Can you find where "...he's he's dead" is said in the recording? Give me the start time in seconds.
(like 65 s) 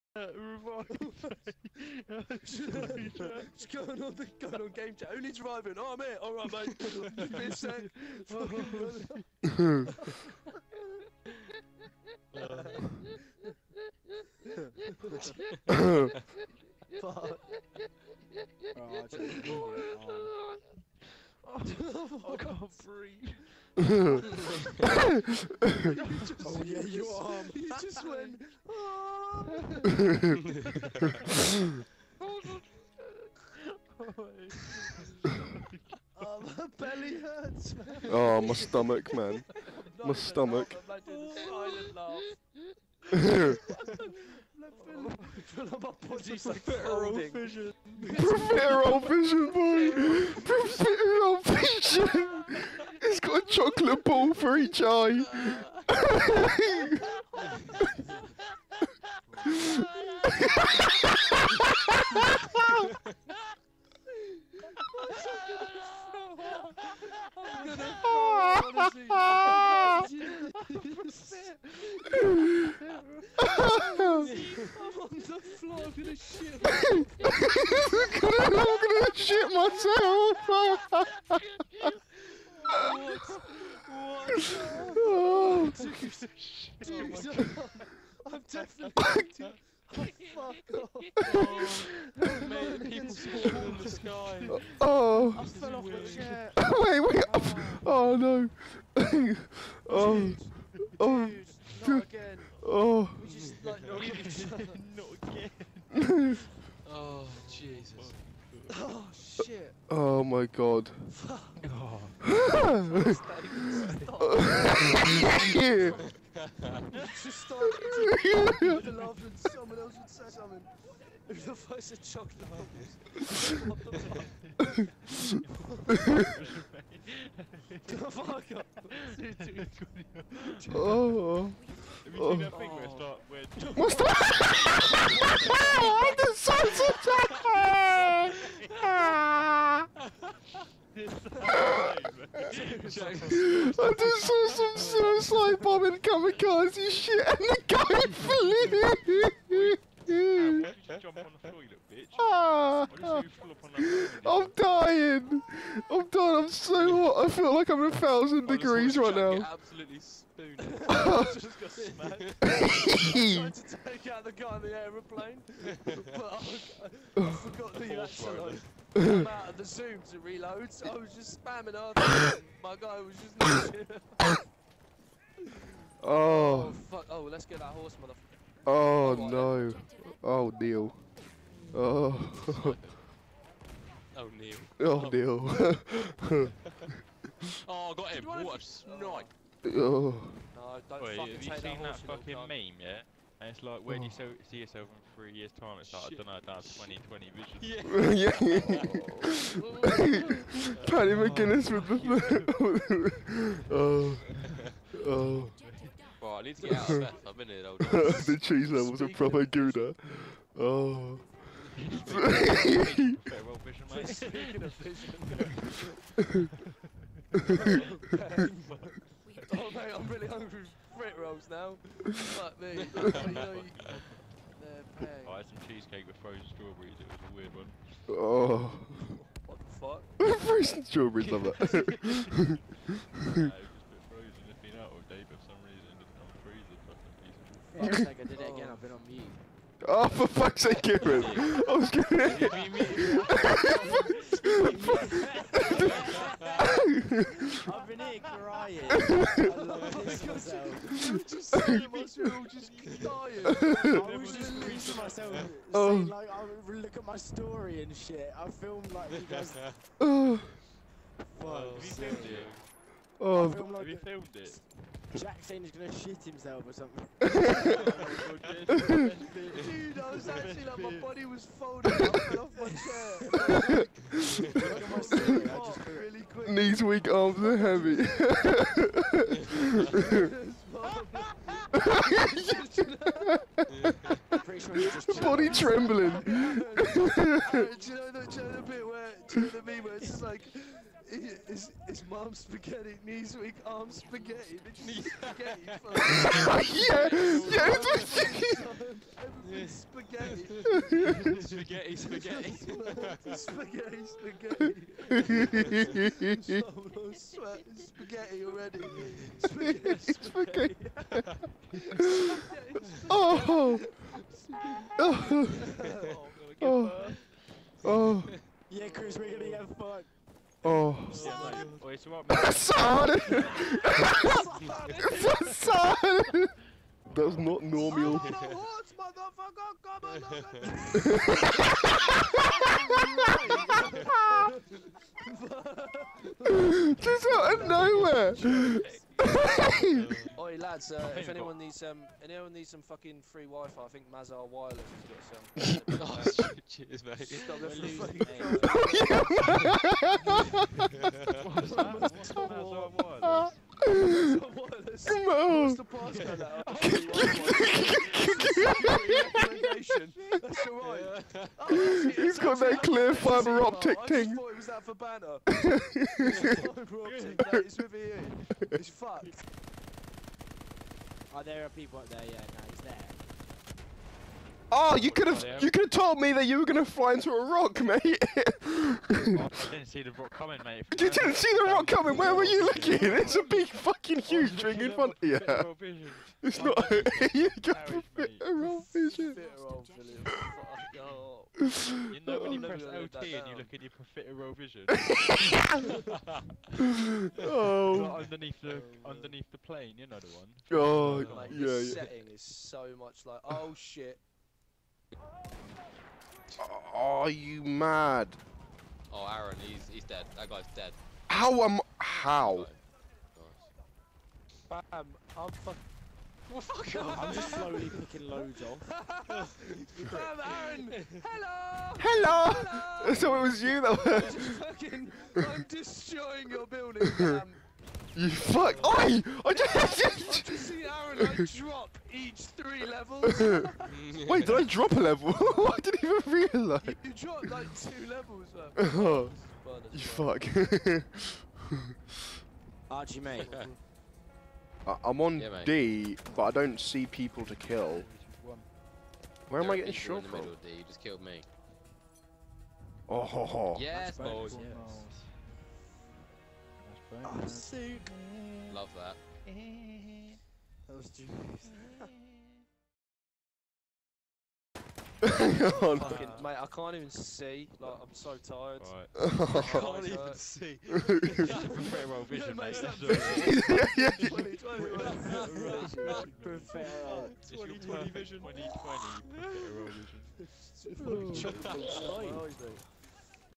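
409 s.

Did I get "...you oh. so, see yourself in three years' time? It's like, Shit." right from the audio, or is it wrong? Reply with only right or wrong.
right.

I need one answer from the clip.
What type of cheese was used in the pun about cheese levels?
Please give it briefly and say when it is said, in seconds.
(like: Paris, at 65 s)
Gouda, at 209 s.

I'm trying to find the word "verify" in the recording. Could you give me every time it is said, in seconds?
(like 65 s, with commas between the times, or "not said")
not said.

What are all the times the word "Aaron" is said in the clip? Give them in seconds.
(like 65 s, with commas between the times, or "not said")
409 s, 420 s, 430 s.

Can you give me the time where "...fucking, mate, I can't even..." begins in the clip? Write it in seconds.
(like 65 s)
465 s.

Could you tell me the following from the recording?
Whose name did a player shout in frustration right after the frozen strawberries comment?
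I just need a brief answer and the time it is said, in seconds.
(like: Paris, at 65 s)
Kieran, at 240 s.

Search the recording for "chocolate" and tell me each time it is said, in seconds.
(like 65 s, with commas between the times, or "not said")
53 s, 122 s.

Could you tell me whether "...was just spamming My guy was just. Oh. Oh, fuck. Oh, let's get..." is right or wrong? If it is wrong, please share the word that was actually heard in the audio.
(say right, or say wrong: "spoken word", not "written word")
right.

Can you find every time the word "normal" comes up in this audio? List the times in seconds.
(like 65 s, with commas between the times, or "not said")
327 s.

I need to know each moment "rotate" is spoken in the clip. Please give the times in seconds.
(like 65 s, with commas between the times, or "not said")
not said.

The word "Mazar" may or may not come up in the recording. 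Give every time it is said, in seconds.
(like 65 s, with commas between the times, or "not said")
344 s, 351 s.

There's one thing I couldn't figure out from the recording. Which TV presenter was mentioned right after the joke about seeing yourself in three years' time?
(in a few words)
Paddy McGuinness.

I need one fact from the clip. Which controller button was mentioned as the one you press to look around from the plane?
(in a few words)
LT.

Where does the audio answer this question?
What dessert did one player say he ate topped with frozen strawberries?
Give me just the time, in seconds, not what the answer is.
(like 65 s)
225 s.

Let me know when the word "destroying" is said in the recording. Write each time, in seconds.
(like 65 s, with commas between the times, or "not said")
425 s.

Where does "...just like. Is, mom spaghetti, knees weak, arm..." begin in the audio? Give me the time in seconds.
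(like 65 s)
290 s.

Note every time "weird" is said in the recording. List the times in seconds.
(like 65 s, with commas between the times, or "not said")
95 s, 227 s.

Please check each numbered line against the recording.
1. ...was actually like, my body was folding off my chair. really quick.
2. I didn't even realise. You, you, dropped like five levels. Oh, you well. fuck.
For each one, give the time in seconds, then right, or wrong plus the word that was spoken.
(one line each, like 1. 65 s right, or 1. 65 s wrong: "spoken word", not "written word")
1. 270 s right
2. 435 s wrong: "two", not "five".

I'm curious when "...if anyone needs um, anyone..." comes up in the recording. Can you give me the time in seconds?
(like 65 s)
341 s.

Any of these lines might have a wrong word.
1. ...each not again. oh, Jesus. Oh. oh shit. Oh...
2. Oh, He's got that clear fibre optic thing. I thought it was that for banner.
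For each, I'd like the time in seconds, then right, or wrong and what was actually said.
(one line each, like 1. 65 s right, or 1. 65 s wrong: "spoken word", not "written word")
1. 104 s right
2. 361 s right.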